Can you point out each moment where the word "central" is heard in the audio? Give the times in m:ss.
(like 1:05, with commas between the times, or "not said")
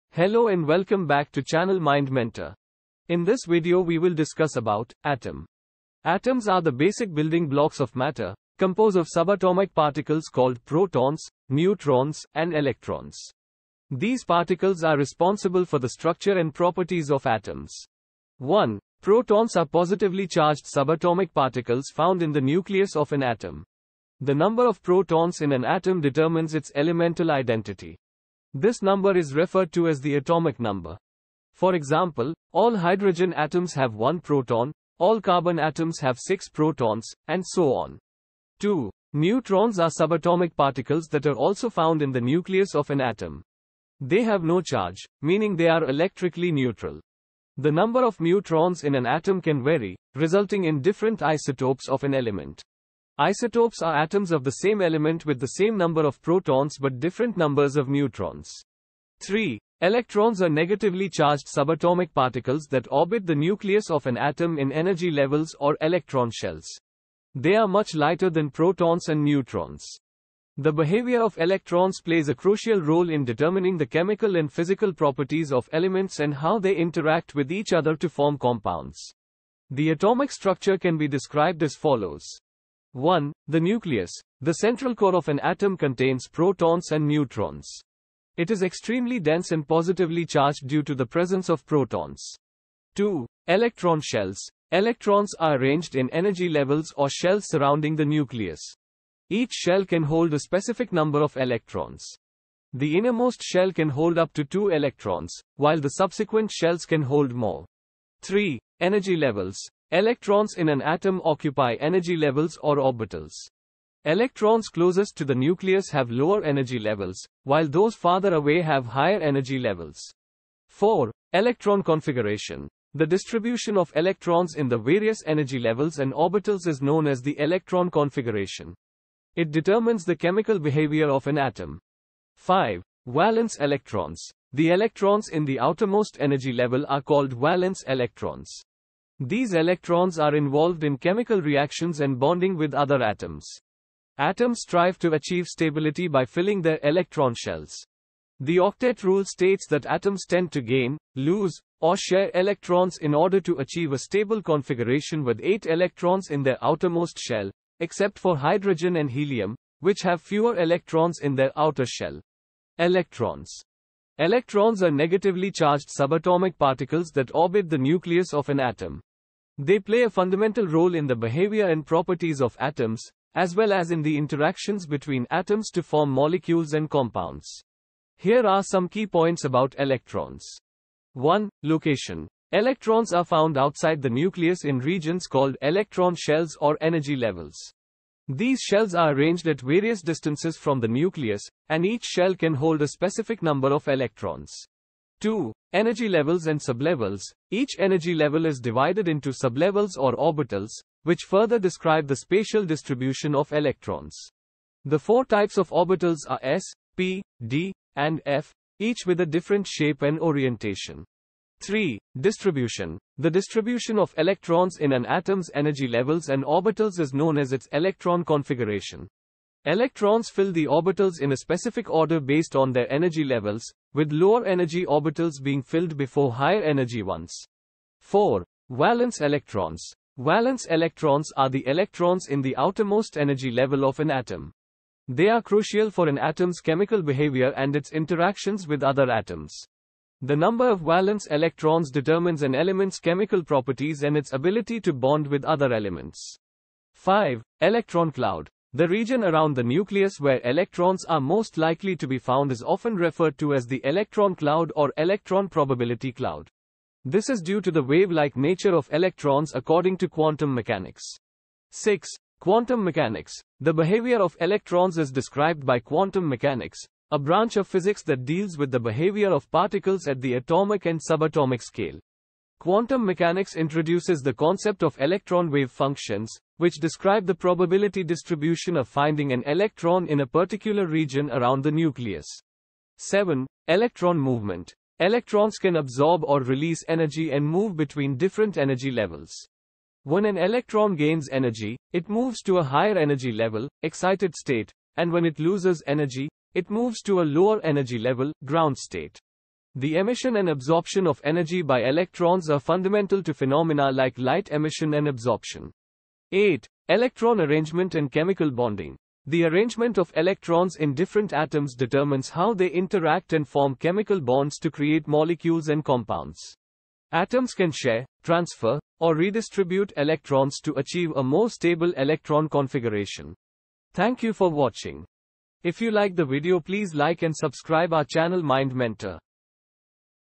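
1:24.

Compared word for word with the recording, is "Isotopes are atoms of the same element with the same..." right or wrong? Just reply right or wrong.
right.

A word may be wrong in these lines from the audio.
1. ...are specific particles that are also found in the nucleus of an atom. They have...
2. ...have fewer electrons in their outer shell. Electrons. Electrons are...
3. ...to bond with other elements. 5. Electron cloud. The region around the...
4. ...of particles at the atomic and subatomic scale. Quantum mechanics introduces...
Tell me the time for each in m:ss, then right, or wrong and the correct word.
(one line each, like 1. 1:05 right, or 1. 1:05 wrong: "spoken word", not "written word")
1. 0:39 wrong: "subatomic", not "specific"
2. 2:40 right
3. 4:04 right
4. 4:29 right.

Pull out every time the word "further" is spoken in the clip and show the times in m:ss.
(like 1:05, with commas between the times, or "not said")
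3:21.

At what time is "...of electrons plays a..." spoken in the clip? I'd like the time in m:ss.
1:11.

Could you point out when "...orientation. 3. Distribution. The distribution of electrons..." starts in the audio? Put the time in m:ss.
3:30.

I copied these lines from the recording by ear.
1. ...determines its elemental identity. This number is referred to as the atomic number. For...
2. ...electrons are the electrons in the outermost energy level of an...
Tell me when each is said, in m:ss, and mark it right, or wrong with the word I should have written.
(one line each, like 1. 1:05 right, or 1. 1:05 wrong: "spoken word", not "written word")
1. 0:26 right
2. 3:50 right.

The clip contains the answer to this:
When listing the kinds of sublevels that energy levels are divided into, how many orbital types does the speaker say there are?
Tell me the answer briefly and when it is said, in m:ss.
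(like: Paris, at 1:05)
4, at 3:24.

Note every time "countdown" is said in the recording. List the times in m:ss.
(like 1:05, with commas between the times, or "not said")
not said.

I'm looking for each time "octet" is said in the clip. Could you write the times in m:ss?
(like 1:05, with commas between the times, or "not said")
2:28.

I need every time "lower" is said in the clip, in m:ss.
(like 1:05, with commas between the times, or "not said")
1:56, 3:44, 4:57.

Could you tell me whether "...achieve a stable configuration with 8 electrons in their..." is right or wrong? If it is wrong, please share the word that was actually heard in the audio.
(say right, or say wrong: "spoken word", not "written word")
right.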